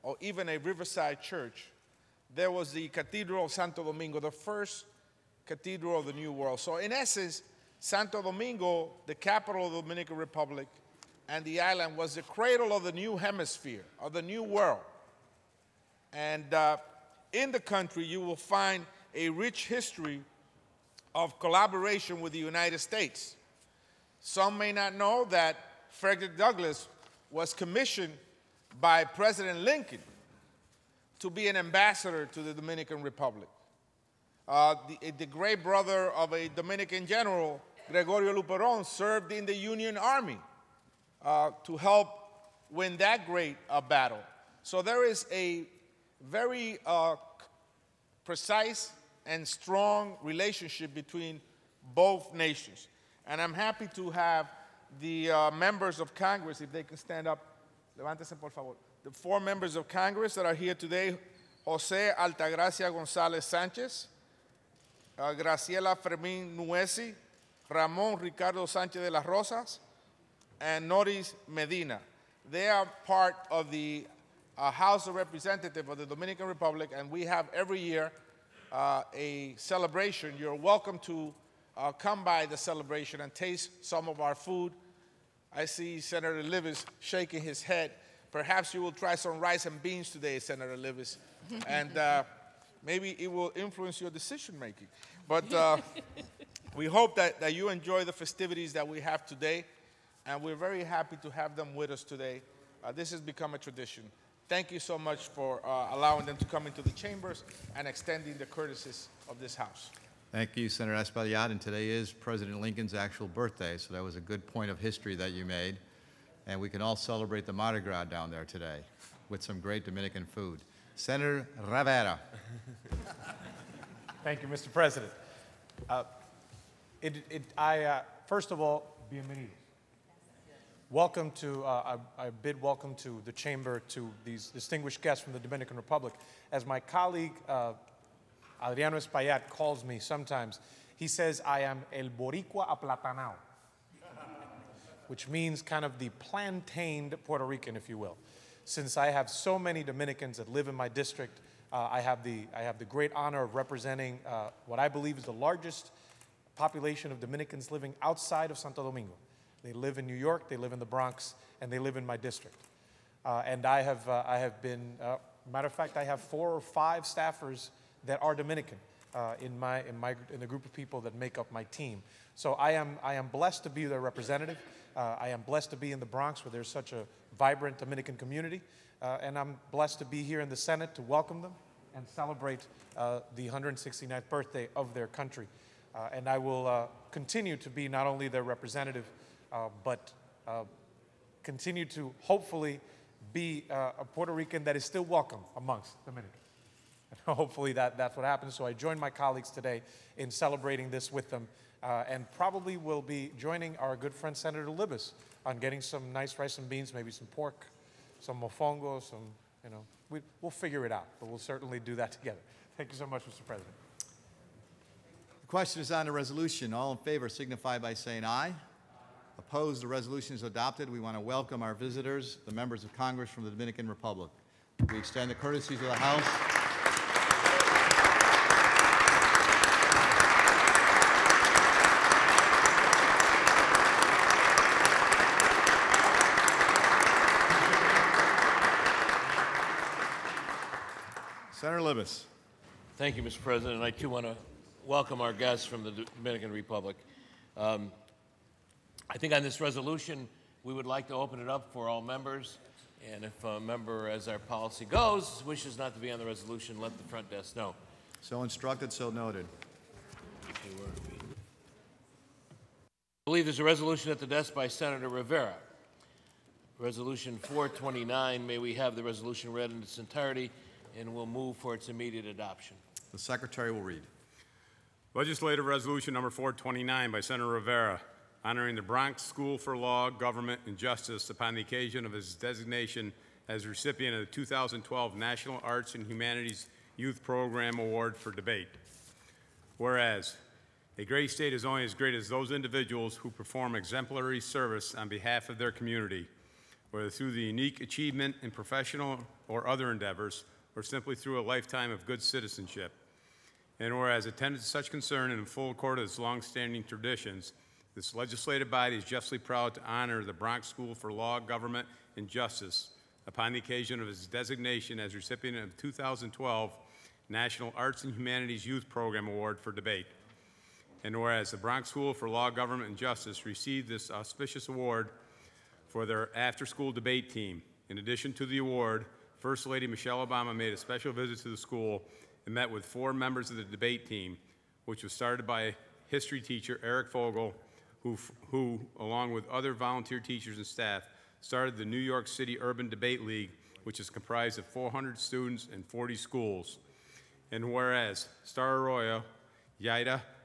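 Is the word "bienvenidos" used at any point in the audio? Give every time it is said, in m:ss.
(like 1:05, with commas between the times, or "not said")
2:09.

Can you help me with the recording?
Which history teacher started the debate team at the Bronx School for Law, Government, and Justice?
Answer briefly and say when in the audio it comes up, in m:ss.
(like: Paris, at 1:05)
Eric Fogel, at 5:36.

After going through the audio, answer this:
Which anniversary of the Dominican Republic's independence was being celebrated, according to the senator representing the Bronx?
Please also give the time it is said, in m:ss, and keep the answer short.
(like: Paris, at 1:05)
169th, at 3:03.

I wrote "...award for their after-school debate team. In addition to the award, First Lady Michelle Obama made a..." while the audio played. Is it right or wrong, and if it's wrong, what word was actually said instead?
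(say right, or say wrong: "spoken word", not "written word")
right.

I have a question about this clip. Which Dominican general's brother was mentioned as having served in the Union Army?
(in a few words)
Gregorio Luperon.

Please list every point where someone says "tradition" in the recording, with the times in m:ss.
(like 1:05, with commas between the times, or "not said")
1:43, 5:06.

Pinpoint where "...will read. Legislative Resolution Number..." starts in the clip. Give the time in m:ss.
4:33.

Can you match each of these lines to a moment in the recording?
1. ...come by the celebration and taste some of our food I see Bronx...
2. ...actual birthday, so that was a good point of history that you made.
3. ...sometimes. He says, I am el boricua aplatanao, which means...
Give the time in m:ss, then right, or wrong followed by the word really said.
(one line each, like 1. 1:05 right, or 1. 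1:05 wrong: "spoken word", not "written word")
1. 1:21 wrong: "Senator", not "Bronx"
2. 1:52 right
3. 2:19 right.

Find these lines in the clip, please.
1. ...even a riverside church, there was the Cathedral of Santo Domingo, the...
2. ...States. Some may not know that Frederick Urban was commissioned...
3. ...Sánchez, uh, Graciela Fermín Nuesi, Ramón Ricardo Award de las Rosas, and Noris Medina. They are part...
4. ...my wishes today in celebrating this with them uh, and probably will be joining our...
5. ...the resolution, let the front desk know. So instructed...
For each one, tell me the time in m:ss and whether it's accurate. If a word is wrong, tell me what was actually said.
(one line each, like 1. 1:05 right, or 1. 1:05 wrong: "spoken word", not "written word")
1. 0:00 right
2. 0:22 wrong: "Douglass", not "Urban"
3. 1:03 wrong: "Sánchez", not "Award"
4. 3:18 wrong: "colleagues", not "wishes"
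5. 4:16 right.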